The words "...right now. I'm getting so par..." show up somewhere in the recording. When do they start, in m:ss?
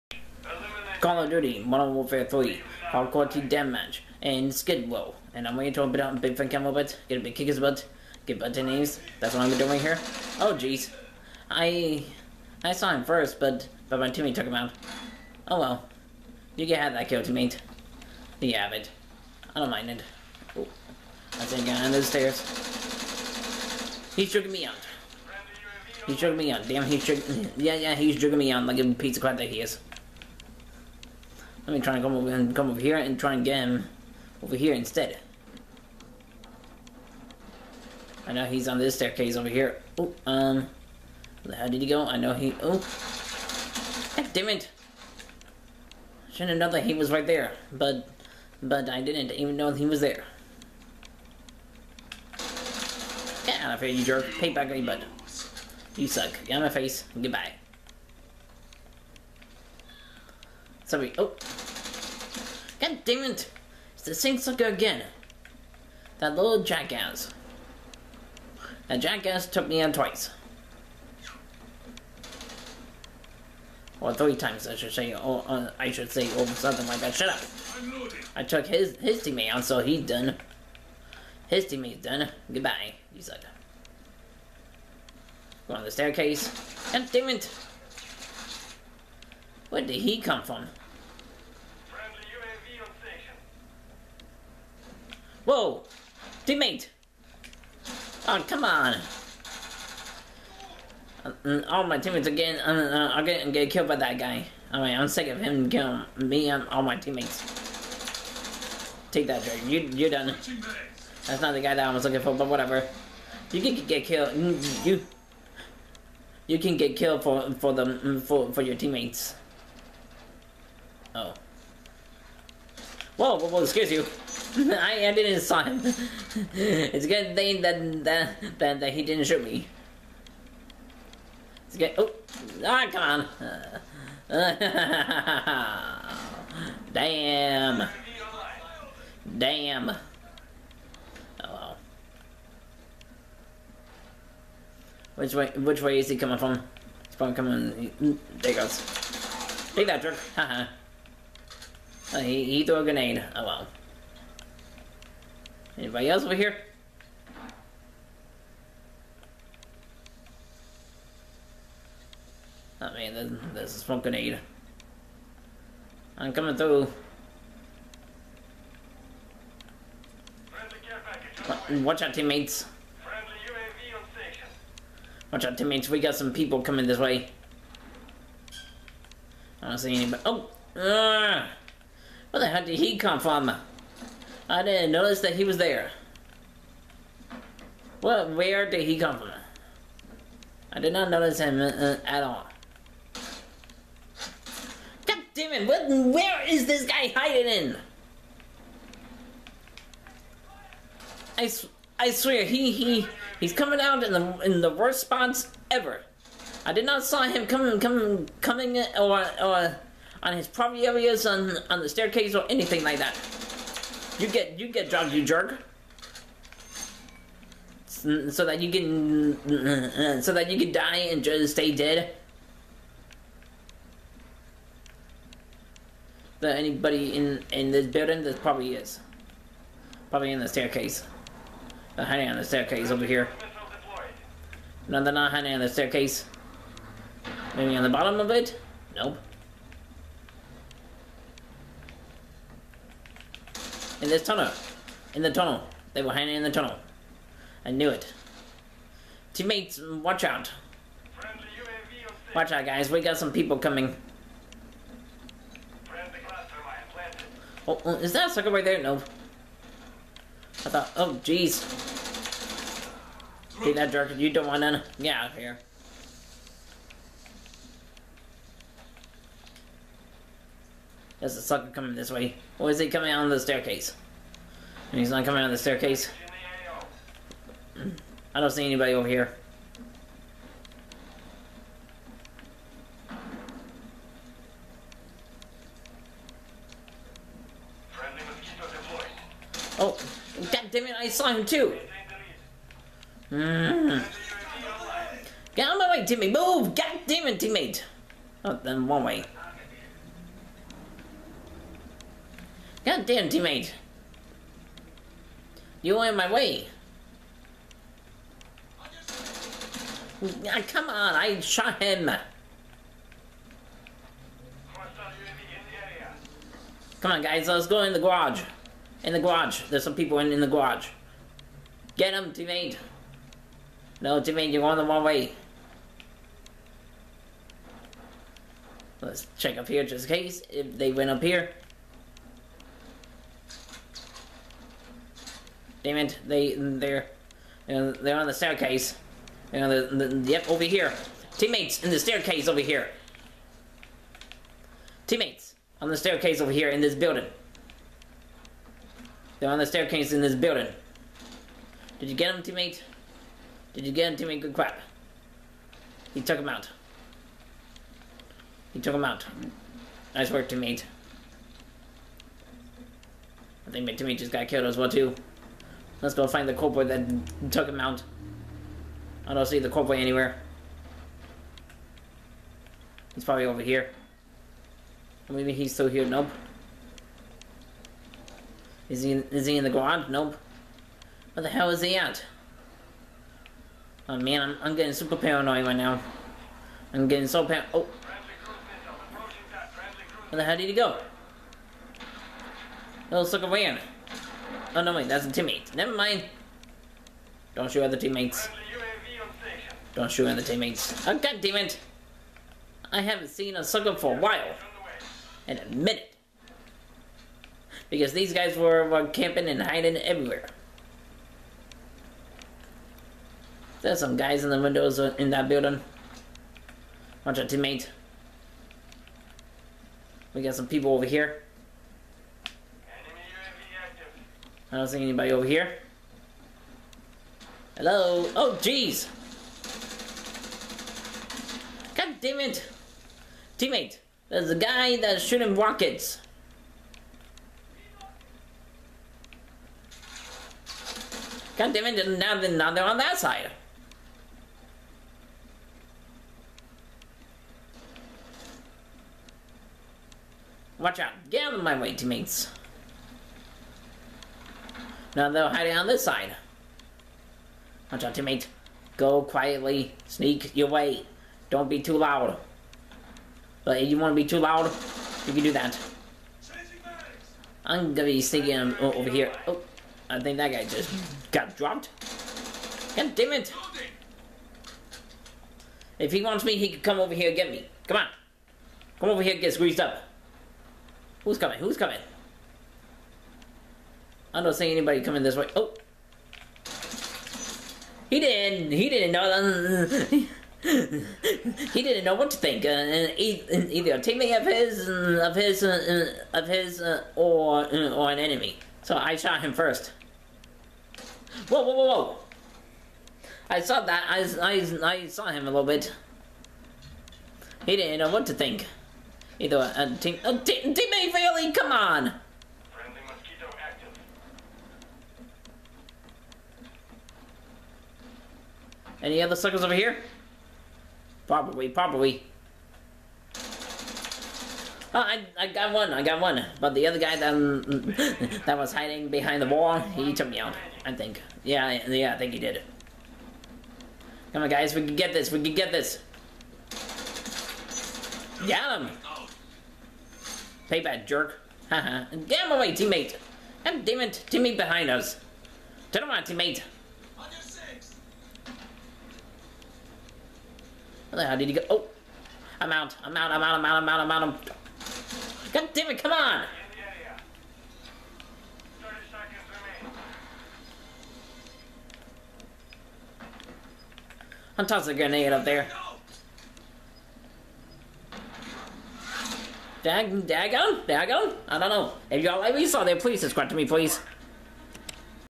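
6:25.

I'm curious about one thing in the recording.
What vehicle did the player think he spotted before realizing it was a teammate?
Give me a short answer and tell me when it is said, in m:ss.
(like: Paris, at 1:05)
a van, at 6:33.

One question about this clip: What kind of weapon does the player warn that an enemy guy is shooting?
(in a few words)
rockets.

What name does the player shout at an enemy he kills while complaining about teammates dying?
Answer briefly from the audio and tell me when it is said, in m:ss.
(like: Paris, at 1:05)
Drake, at 1:49.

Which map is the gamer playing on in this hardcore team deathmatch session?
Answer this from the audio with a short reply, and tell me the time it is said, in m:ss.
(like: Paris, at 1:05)
Skidrow, at 0:04.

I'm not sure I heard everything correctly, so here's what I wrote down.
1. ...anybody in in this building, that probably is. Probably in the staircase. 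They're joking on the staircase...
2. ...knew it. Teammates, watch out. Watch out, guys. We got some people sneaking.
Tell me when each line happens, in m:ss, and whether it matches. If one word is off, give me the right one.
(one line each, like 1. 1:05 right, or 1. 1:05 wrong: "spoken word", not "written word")
1. 3:46 wrong: "hiding", not "joking"
2. 4:07 wrong: "coming", not "sneaking".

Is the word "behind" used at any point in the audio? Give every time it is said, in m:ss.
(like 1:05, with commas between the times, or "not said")
8:49, 9:04.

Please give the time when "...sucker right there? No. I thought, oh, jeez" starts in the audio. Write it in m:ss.
4:18.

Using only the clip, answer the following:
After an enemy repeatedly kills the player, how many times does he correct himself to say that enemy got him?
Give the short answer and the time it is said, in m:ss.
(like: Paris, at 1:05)
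3, at 1:14.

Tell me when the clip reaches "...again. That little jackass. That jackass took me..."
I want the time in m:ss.
1:04.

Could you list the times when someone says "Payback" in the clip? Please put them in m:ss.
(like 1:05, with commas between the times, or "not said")
9:00.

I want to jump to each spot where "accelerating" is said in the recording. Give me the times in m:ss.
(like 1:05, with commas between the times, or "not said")
not said.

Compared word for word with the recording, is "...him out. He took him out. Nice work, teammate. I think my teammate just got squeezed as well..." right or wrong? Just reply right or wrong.
wrong.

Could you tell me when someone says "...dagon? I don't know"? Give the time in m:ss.
9:30.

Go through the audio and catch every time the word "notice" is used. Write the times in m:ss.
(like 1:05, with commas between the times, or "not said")
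3:04, 3:11.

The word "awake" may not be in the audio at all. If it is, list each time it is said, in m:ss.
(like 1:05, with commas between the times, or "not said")
not said.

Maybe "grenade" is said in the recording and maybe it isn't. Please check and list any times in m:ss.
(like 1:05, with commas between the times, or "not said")
2:32, 2:44, 9:24.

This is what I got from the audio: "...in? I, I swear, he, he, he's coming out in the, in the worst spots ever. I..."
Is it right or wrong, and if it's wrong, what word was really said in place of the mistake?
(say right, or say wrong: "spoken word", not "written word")
right.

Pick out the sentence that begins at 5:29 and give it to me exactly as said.
Let's check up here just in case if they went up here.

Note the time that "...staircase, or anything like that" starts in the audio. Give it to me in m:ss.
3:31.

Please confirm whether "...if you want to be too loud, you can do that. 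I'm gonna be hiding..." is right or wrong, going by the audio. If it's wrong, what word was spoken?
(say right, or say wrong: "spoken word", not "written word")
wrong: "sneaking", not "hiding".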